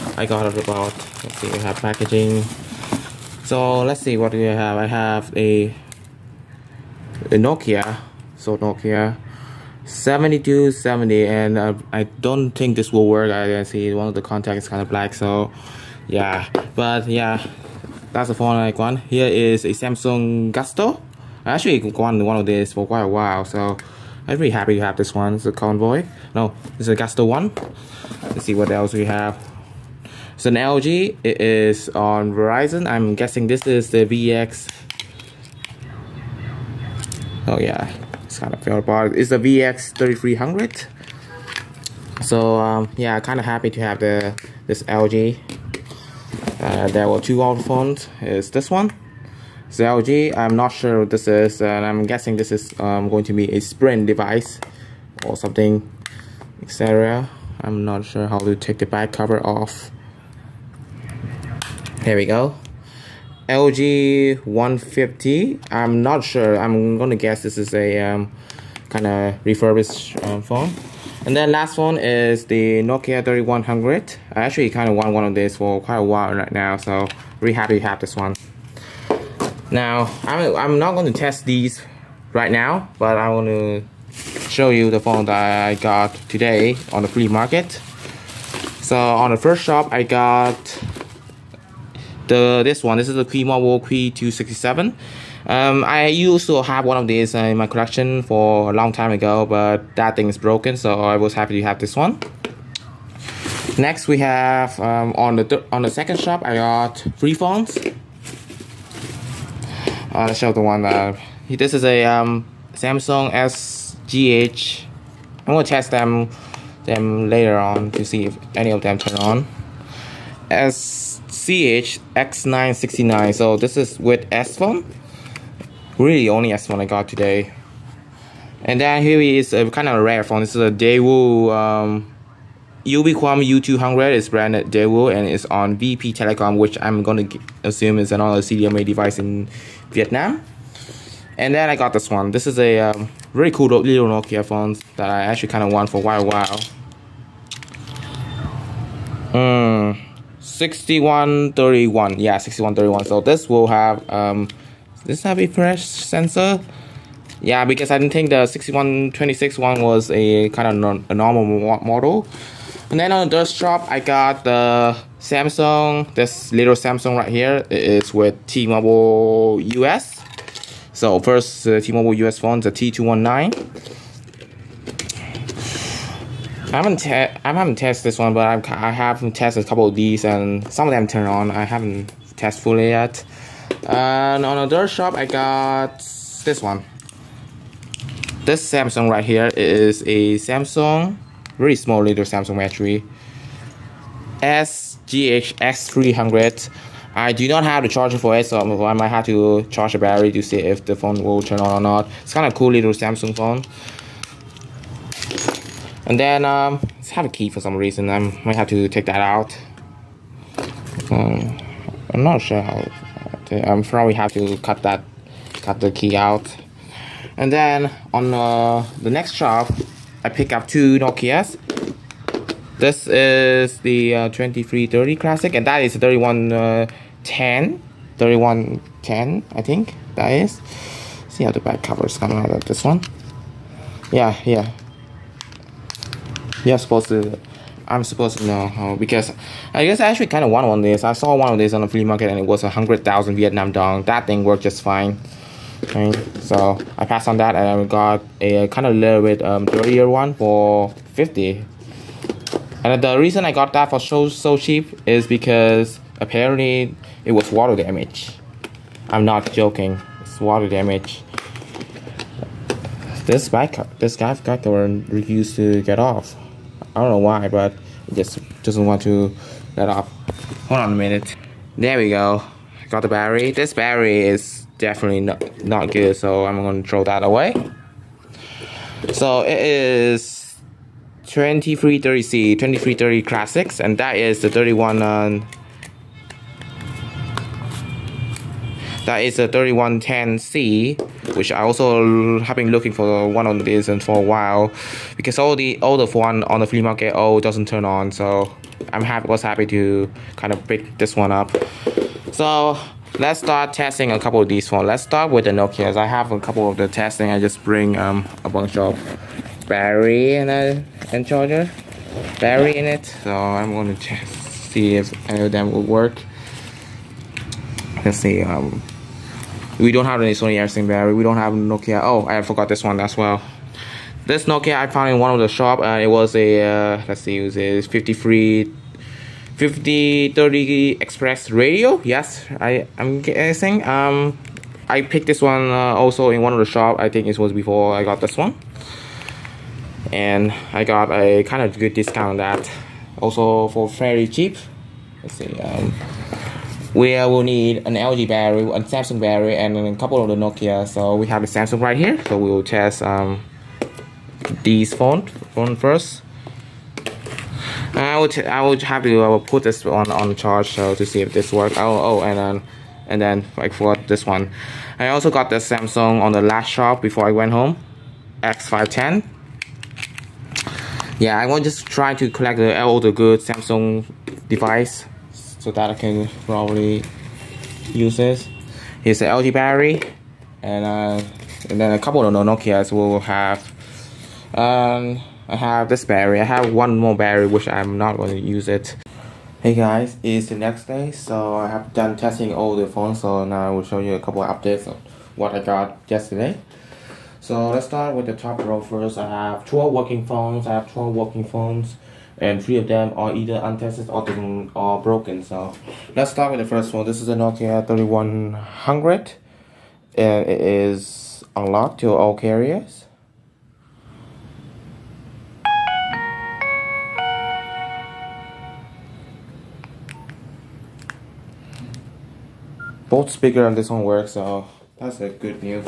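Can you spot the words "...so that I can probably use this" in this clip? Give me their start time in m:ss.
6:15.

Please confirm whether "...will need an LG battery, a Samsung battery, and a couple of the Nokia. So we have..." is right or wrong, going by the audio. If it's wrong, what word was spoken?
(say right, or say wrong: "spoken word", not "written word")
right.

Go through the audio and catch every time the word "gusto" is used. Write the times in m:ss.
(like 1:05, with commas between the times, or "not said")
0:20, 0:26.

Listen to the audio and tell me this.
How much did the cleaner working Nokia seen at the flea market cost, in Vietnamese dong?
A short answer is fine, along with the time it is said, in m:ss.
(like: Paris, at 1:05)
100,000 dong, at 4:02.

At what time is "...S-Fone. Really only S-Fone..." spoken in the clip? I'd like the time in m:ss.
2:04.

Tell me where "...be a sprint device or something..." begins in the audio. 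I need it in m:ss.
0:53.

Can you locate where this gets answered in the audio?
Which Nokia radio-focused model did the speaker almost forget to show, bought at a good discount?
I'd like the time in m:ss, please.
5:29.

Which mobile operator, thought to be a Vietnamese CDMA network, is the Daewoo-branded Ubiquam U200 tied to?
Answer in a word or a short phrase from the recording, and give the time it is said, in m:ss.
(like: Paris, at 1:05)
VP Telecom, at 2:15.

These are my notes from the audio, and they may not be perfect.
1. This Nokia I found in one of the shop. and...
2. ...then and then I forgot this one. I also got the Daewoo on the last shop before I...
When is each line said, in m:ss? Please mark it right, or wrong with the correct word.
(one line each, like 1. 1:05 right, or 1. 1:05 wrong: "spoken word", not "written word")
1. 5:24 right
2. 6:02 wrong: "Samsung", not "Daewoo".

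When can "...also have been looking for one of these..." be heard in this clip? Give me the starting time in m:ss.
4:51.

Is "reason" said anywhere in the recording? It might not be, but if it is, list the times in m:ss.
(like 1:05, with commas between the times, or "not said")
3:27, 4:13.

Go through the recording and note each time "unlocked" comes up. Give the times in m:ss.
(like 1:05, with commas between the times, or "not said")
6:51.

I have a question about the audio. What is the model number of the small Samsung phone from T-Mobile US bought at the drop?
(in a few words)
T219.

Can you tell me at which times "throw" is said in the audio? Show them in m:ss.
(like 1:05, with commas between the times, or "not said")
4:36.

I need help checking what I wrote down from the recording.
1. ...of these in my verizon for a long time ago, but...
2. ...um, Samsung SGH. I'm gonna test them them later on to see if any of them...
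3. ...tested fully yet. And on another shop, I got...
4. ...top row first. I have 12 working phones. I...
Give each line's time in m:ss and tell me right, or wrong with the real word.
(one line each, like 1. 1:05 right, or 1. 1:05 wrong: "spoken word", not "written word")
1. 1:36 wrong: "collection", not "verizon"
2. 1:52 right
3. 3:02 right
4. 6:38 right.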